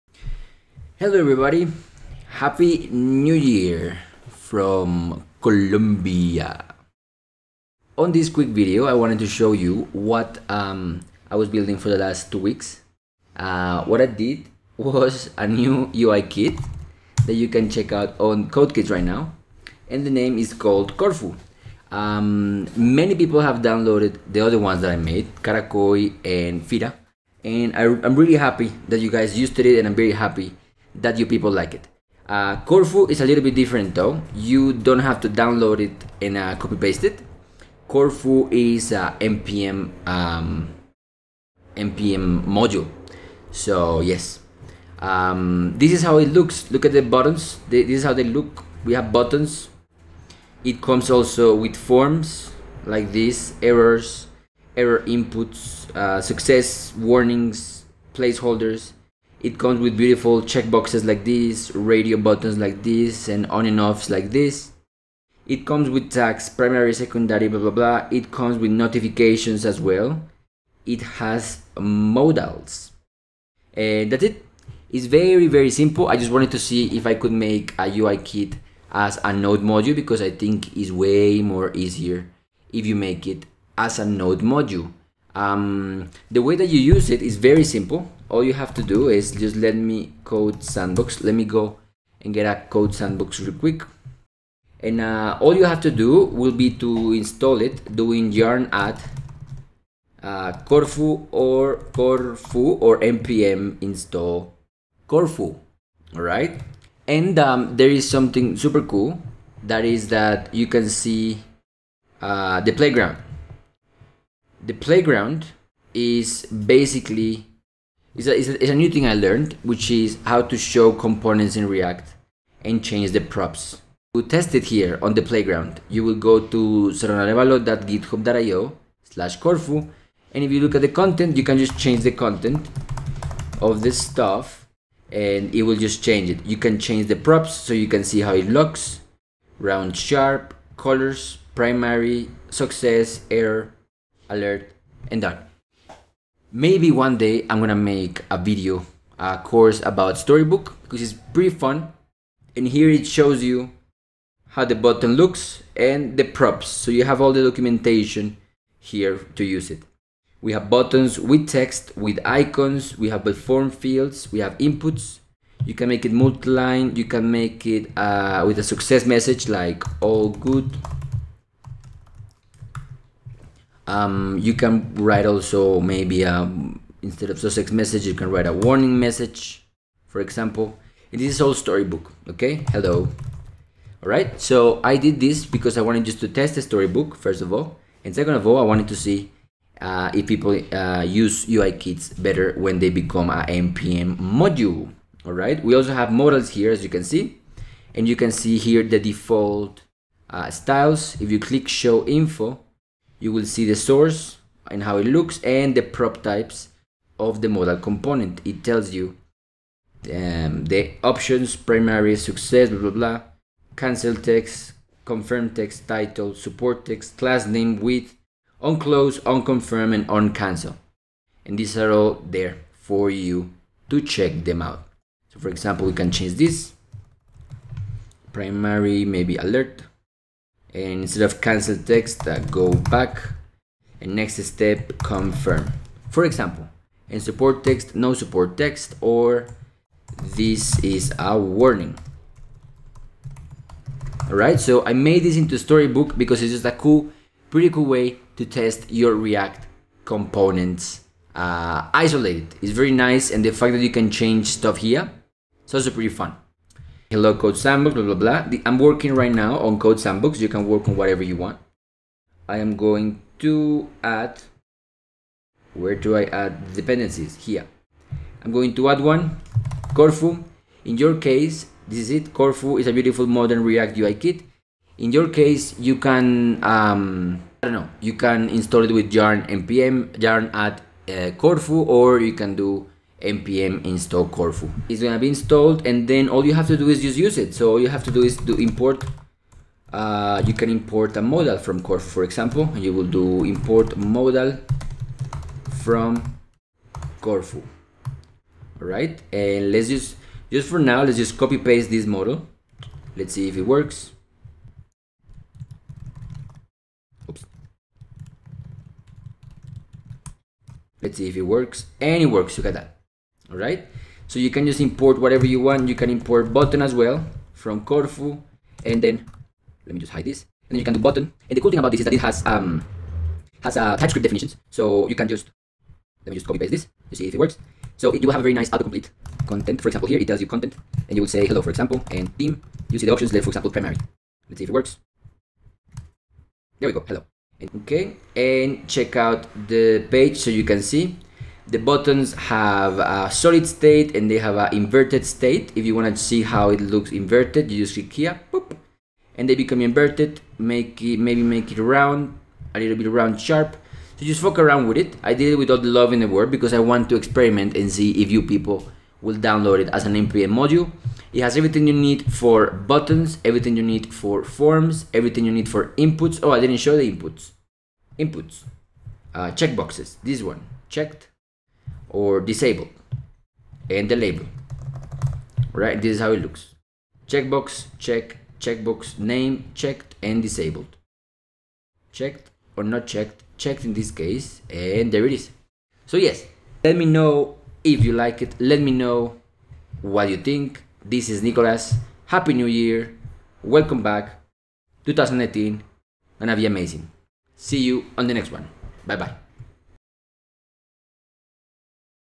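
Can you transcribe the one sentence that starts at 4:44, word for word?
It's gonna be installed and then all you have to do is just use it.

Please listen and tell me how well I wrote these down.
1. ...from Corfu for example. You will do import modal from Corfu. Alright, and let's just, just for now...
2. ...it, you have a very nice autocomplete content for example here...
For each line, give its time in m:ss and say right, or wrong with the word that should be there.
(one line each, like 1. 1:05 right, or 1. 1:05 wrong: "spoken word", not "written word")
1. 4:51 right
2. 5:28 right.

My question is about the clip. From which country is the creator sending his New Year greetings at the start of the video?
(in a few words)
Colombia.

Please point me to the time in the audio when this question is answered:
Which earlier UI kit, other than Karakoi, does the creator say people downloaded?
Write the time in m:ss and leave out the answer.
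0:26.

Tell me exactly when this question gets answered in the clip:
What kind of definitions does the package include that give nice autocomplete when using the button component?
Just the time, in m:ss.
5:23.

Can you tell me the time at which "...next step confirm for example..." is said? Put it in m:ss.
3:54.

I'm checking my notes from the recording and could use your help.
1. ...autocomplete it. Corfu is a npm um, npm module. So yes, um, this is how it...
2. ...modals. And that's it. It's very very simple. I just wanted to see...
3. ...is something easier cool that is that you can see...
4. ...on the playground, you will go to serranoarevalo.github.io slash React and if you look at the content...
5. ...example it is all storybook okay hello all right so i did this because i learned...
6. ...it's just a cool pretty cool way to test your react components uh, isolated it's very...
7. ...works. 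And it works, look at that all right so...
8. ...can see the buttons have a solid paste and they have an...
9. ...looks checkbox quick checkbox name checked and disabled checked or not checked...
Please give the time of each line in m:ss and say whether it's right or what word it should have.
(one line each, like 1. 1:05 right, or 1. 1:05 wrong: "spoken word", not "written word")
1. 0:36 wrong: "paste", not "autocomplete"
2. 1:11 right
3. 1:47 wrong: "super", not "easier"
4. 2:05 wrong: "Corfu", not "React"
5. 3:00 wrong: "wanted", not "learned"
6. 4:06 right
7. 5:11 right
8. 5:40 wrong: "state", not "paste"
9. 6:16 wrong: "check", not "quick".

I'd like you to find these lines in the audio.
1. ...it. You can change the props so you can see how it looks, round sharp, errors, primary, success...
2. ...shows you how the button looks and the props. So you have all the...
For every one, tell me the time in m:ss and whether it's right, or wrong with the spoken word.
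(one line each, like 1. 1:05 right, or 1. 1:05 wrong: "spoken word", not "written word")
1. 2:16 wrong: "colors", not "errors"
2. 2:33 right.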